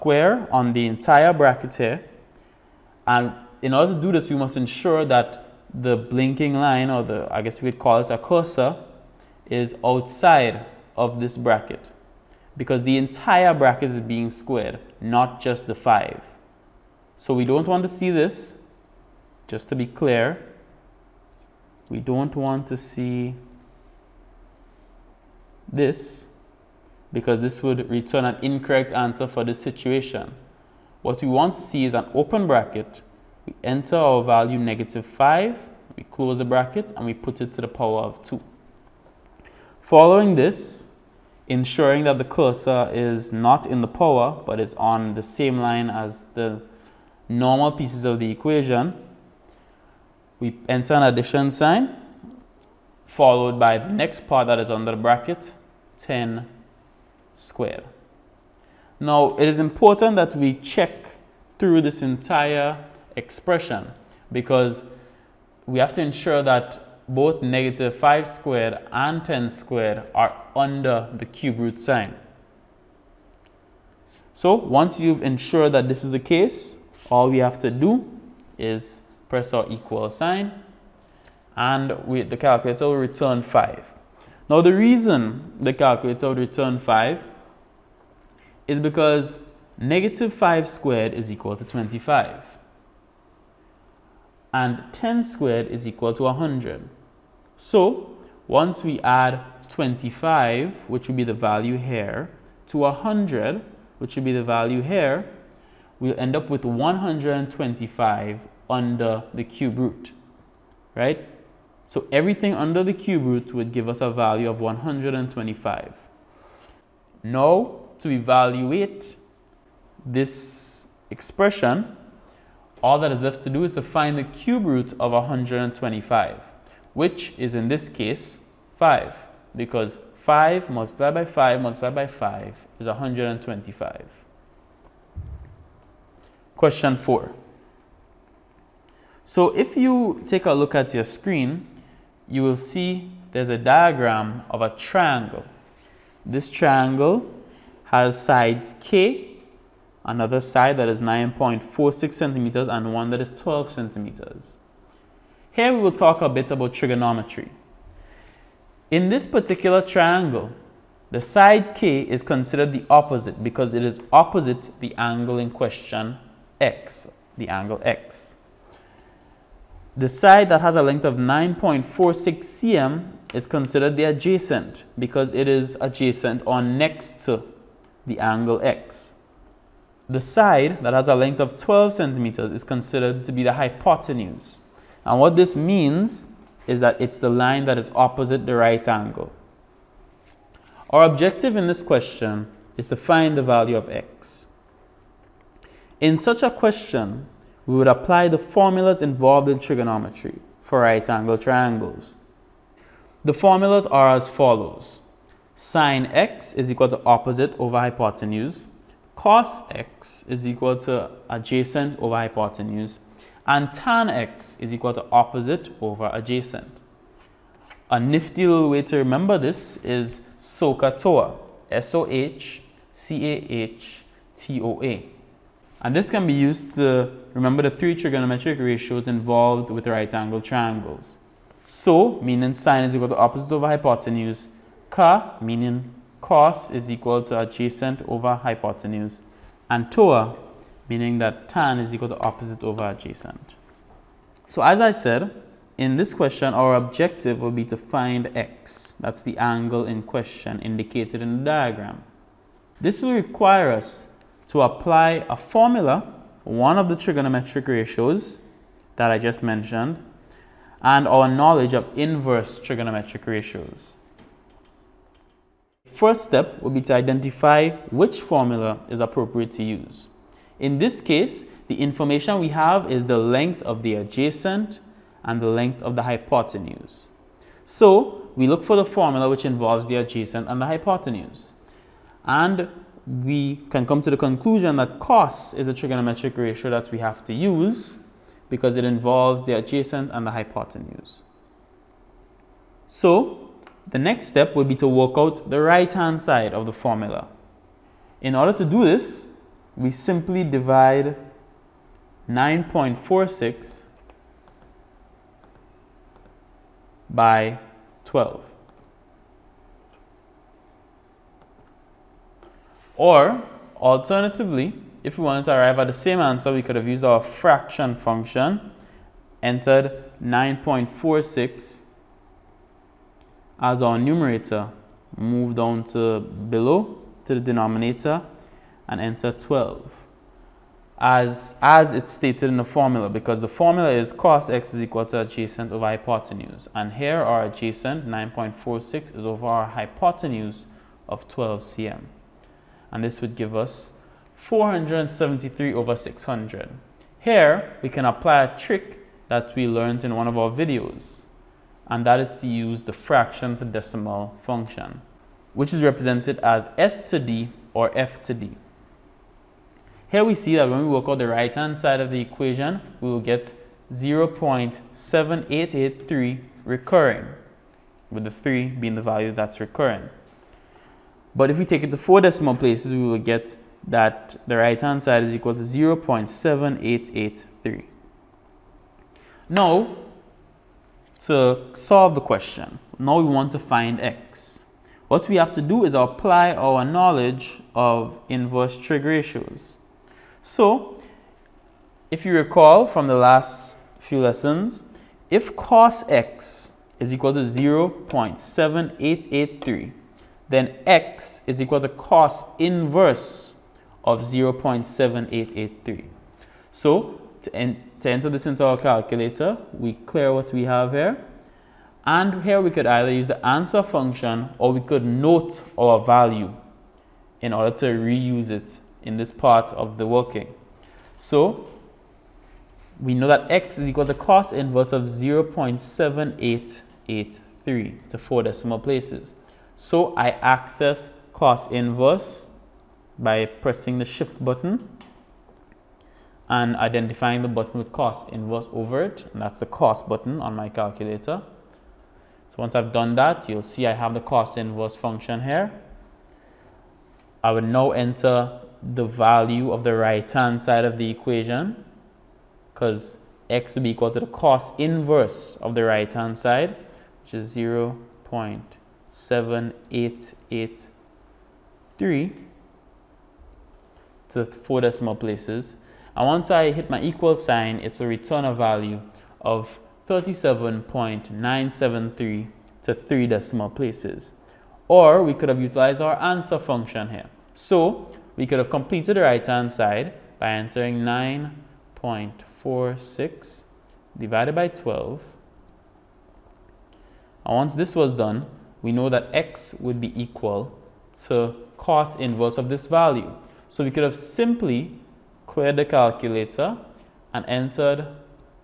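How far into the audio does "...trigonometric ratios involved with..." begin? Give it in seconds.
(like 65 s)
227 s.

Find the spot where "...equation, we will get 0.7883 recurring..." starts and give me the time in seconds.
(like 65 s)
362 s.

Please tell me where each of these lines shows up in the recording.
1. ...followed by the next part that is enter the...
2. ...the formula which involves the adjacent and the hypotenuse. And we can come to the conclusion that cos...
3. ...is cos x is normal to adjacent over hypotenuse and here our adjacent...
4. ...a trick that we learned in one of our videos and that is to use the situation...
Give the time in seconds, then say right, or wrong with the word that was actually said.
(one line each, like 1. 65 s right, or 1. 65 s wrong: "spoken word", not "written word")
1. 53 s wrong: "under", not "enter"
2. 278 s right
3. 333 s wrong: "equal", not "normal"
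4. 348 s wrong: "fraction", not "situation".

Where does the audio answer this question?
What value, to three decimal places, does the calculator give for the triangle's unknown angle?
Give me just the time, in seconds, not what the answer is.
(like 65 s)
470 s.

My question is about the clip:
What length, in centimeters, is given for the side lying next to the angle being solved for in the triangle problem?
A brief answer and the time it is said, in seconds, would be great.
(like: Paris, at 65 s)
9.46, at 151 s.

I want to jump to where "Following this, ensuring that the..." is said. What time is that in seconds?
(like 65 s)
39 s.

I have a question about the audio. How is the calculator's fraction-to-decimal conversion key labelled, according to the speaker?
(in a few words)
S to D.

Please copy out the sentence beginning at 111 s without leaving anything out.
So everything under the cube root would give us a value of 125.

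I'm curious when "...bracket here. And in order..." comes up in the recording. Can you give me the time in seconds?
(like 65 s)
1 s.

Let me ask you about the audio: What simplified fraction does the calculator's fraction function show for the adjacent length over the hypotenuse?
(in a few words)
473/600.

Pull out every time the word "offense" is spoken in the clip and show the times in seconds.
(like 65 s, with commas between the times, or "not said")
not said.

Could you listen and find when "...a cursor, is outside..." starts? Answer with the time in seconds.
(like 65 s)
8 s.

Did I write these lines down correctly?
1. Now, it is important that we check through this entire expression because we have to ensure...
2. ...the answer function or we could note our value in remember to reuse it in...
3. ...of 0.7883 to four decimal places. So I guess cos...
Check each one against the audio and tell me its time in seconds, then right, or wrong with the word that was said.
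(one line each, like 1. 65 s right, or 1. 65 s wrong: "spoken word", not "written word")
1. 59 s right
2. 413 s wrong: "order", not "remember"
3. 424 s wrong: "access", not "guess".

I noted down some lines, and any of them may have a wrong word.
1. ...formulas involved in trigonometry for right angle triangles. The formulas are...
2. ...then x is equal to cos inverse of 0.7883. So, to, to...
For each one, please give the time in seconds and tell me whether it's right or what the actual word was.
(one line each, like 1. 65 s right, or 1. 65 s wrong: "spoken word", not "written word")
1. 198 s right
2. 400 s right.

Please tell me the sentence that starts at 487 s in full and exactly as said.
And once this was done, we know that x would be equal to cos inverse of this value.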